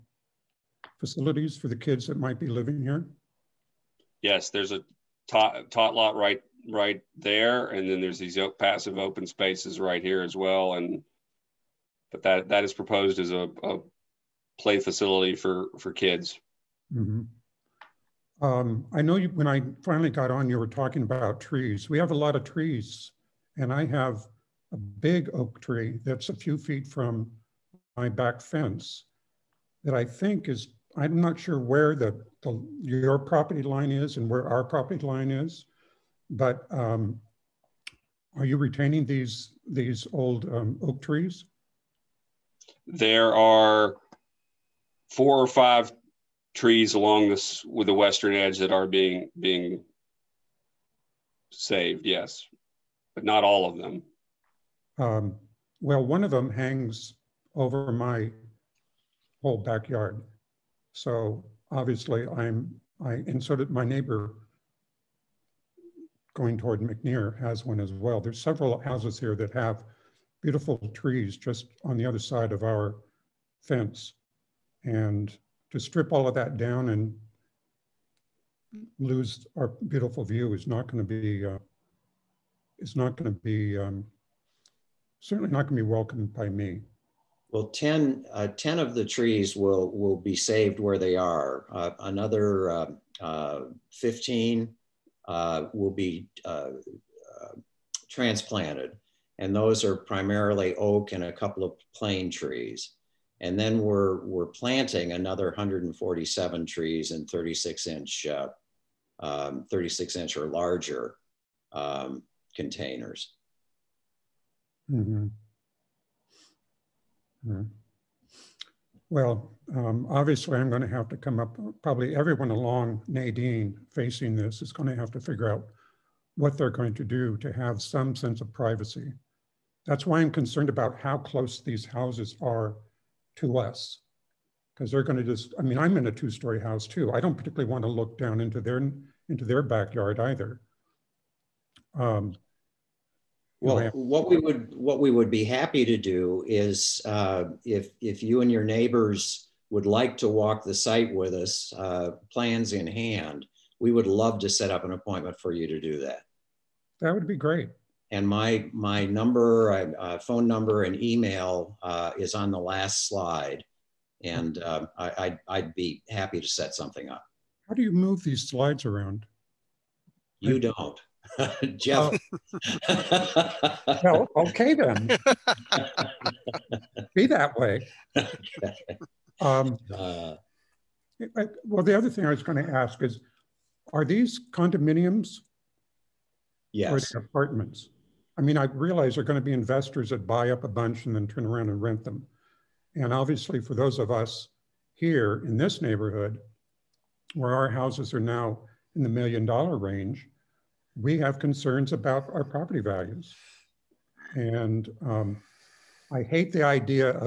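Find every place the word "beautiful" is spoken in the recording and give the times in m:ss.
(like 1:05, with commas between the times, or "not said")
1:10, 1:19.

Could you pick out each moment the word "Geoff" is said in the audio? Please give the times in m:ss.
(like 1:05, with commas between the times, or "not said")
2:51.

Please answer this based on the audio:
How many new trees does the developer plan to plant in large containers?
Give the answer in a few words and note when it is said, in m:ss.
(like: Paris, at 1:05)
147, at 1:45.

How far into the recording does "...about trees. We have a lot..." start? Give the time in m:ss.
0:21.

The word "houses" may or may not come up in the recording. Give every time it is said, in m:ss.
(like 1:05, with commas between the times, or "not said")
1:08, 2:11, 2:16, 3:17.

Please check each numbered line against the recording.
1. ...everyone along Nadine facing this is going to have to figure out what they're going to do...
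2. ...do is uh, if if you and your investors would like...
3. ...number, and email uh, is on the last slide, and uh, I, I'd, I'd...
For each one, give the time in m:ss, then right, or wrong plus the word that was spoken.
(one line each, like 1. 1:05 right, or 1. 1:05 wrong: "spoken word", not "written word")
1. 2:02 right
2. 2:25 wrong: "neighbors", not "investors"
3. 2:40 right.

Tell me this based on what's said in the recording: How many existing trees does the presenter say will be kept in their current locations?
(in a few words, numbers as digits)
10.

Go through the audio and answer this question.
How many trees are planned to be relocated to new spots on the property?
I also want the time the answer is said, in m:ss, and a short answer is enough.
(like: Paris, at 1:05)
15, at 1:33.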